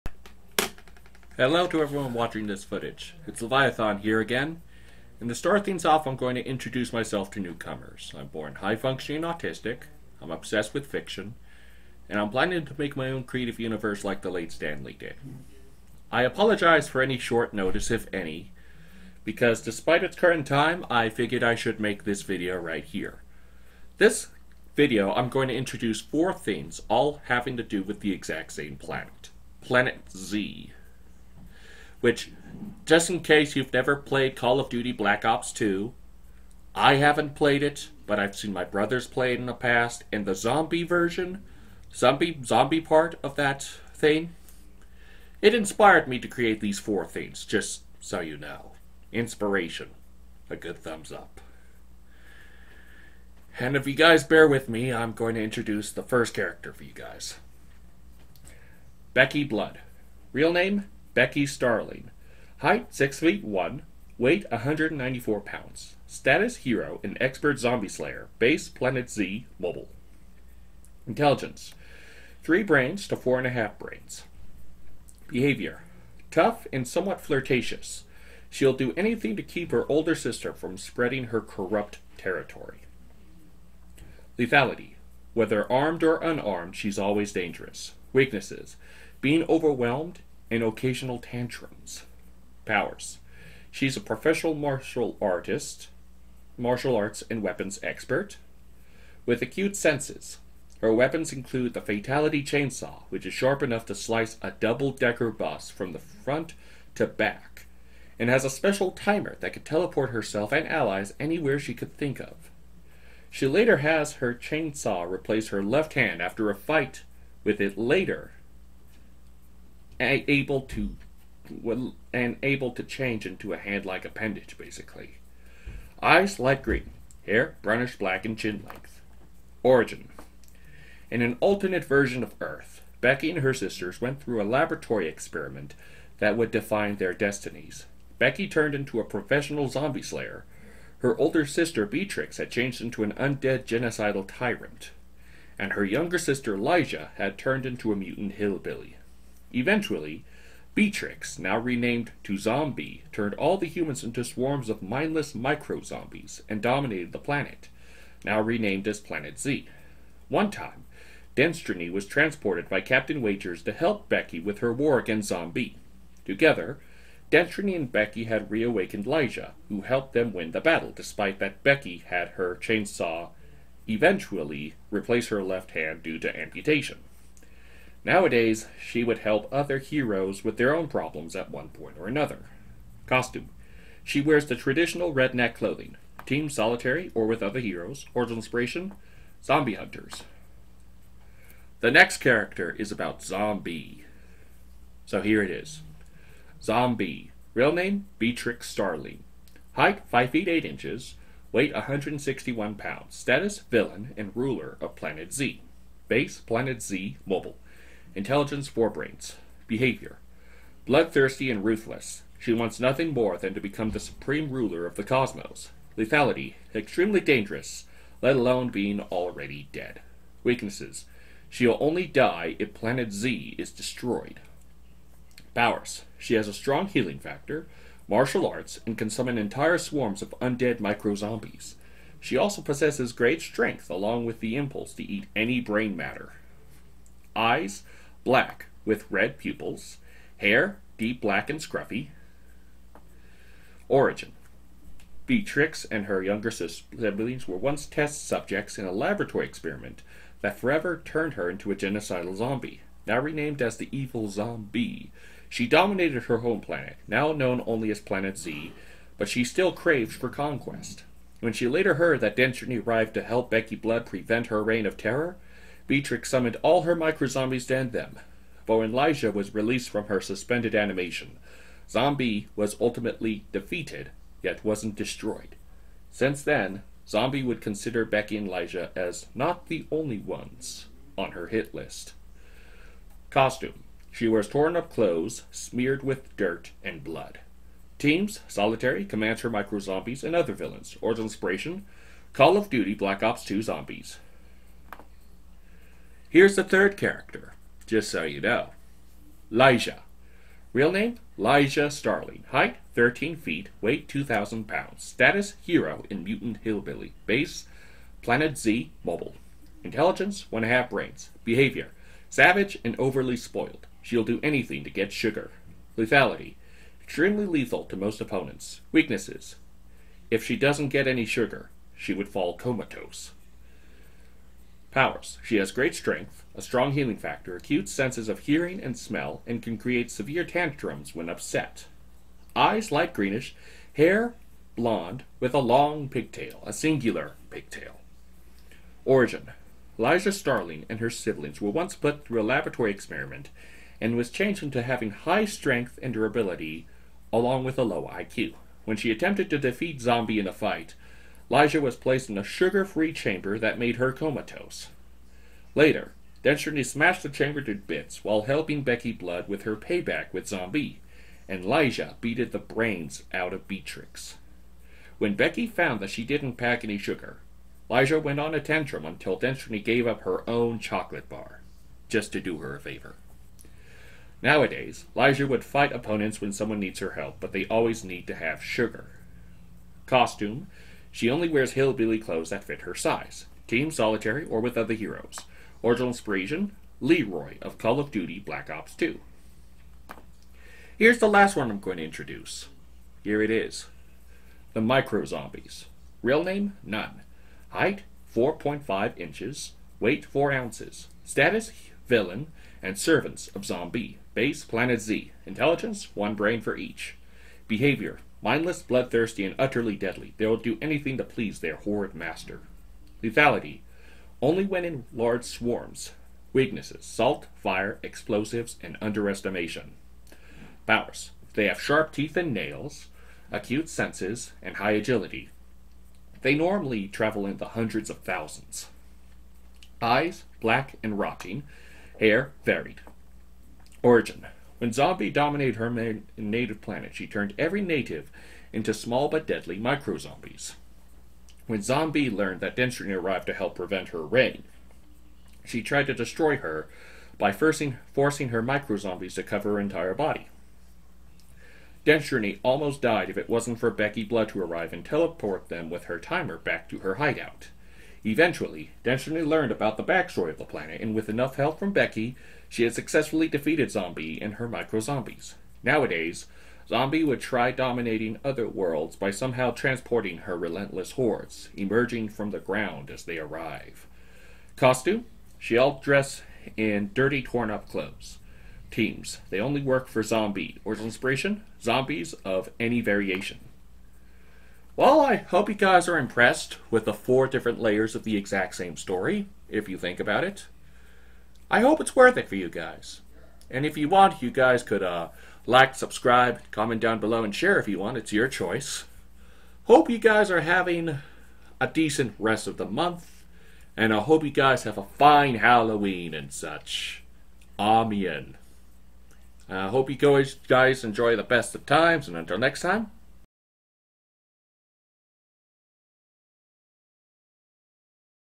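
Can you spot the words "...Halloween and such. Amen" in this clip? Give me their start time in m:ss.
8:25.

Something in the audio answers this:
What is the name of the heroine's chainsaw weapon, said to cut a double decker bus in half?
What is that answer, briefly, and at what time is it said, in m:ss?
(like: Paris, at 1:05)
Fatality Chainsaw, at 1:41.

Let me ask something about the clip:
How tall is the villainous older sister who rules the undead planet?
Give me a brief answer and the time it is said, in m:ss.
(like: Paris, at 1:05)
5 feet 8 inches, at 3:20.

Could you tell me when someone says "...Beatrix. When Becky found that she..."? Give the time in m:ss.
6:03.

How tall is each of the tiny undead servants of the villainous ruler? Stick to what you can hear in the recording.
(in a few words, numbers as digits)
4.5 inches.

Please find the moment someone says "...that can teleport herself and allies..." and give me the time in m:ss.
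1:49.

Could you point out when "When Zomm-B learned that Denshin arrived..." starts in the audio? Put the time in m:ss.
7:21.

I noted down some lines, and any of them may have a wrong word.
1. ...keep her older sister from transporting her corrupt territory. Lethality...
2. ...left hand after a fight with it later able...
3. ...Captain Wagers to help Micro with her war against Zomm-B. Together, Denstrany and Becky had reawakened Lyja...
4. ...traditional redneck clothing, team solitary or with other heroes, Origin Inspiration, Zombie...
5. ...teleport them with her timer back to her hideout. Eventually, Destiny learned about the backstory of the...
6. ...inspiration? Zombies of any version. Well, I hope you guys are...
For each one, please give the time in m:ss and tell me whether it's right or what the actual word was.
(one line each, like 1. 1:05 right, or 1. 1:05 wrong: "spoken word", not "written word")
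1. 1:19 wrong: "spreading", not "transporting"
2. 1:55 right
3. 2:42 wrong: "Becky", not "Micro"
4. 3:04 right
5. 7:35 right
6. 8:01 wrong: "variation", not "version".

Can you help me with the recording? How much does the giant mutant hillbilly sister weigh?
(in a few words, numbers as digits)
2,000 pounds.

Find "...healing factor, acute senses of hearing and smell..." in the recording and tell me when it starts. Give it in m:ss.
5:26.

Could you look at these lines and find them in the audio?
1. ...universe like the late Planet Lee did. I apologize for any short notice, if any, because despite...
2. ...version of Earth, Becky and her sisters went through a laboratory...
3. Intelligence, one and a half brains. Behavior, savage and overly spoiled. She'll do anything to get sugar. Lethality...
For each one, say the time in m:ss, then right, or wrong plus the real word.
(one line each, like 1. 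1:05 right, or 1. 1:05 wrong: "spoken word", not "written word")
1. 0:13 wrong: "Stan", not "Planet"
2. 2:11 right
3. 5:09 right.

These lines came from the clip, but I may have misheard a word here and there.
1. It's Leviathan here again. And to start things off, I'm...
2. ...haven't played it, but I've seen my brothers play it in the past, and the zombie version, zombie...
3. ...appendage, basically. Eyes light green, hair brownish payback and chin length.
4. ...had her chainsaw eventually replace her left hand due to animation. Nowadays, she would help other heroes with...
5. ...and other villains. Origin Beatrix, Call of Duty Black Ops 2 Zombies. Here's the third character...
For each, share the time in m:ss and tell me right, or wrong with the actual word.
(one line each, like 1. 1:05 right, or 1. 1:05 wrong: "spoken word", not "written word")
1. 0:03 right
2. 0:36 right
3. 2:04 wrong: "black", not "payback"
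4. 2:52 wrong: "amputation", not "animation"
5. 4:50 wrong: "Inspiration", not "Beatrix".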